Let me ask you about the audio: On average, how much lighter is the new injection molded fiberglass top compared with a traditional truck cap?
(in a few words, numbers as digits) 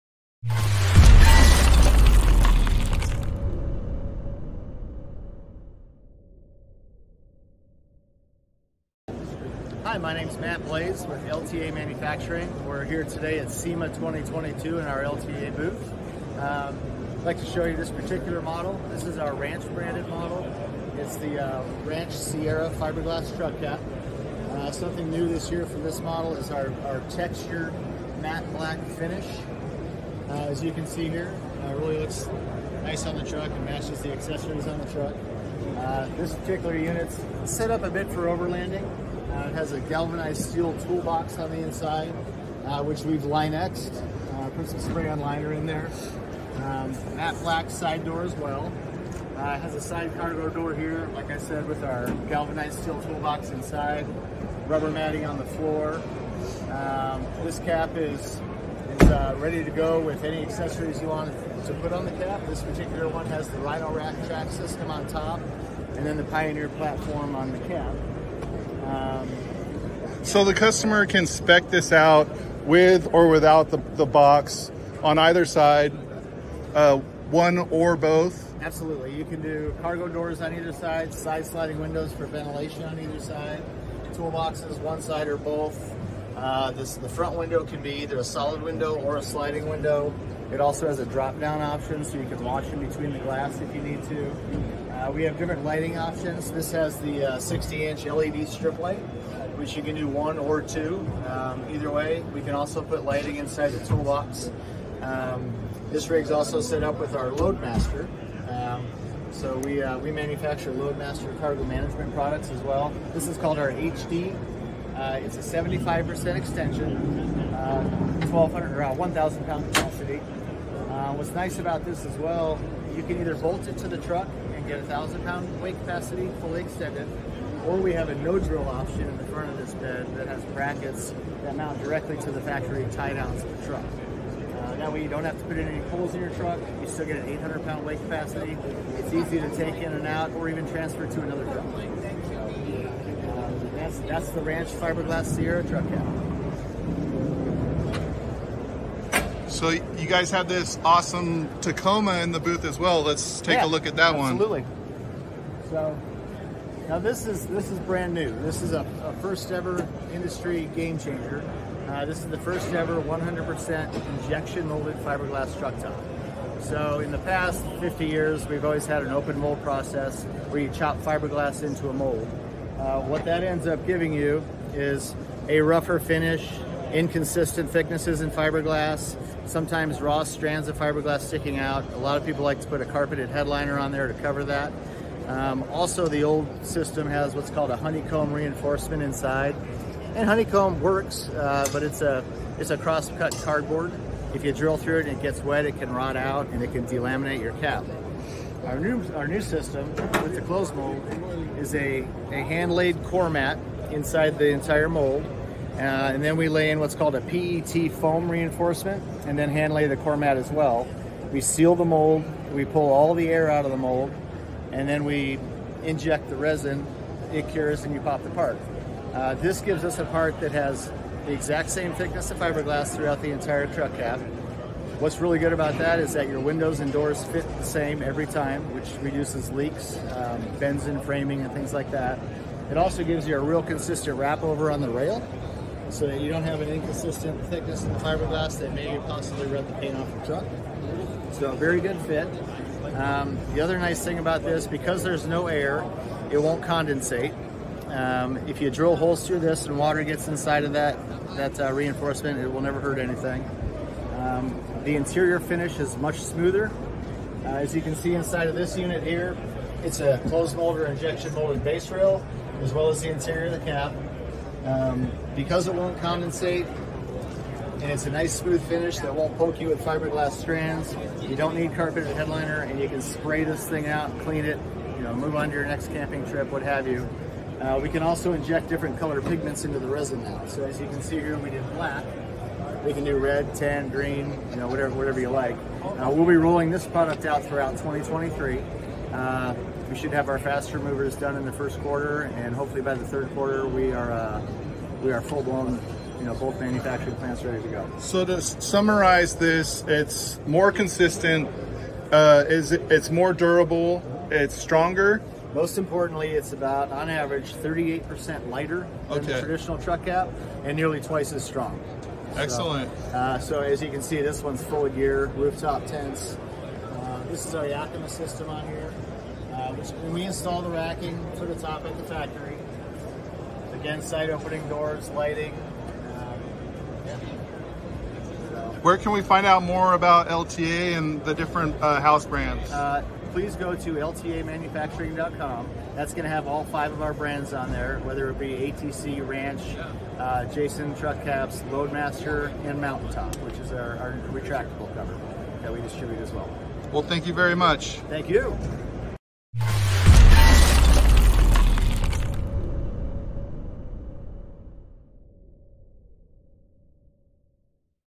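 38%.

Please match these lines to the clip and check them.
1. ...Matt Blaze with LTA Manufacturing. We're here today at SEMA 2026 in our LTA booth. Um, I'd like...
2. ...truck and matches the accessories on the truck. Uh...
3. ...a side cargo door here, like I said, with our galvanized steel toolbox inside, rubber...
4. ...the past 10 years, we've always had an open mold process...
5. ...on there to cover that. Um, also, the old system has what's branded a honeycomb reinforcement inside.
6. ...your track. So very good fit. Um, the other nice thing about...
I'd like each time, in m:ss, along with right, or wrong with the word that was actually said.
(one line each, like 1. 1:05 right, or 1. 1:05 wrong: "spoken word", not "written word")
1. 0:10 wrong: "2022", not "2026"
2. 0:33 right
3. 0:49 right
4. 2:47 wrong: "50", not "10"
5. 3:03 wrong: "called", not "branded"
6. 4:00 wrong: "truck", not "track".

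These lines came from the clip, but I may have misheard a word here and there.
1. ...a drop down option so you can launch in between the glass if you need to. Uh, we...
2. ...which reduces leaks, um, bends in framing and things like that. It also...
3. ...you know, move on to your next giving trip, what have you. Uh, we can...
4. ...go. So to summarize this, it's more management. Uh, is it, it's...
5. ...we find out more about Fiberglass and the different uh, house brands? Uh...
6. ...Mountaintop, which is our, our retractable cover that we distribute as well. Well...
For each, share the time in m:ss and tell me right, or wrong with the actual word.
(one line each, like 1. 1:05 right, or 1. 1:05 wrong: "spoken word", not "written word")
1. 1:30 right
2. 3:48 right
3. 4:34 wrong: "camping", not "giving"
4. 4:57 wrong: "consistent", not "management"
5. 5:29 wrong: "LTA", not "Fiberglass"
6. 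5:42 right.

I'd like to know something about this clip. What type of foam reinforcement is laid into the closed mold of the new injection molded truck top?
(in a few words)
PET foam.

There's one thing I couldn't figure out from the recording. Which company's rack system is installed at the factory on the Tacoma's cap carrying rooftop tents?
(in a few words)
Yakima.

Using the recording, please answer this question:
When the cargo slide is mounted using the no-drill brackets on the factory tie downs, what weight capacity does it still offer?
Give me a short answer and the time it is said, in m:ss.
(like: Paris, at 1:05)
800 pounds, at 2:17.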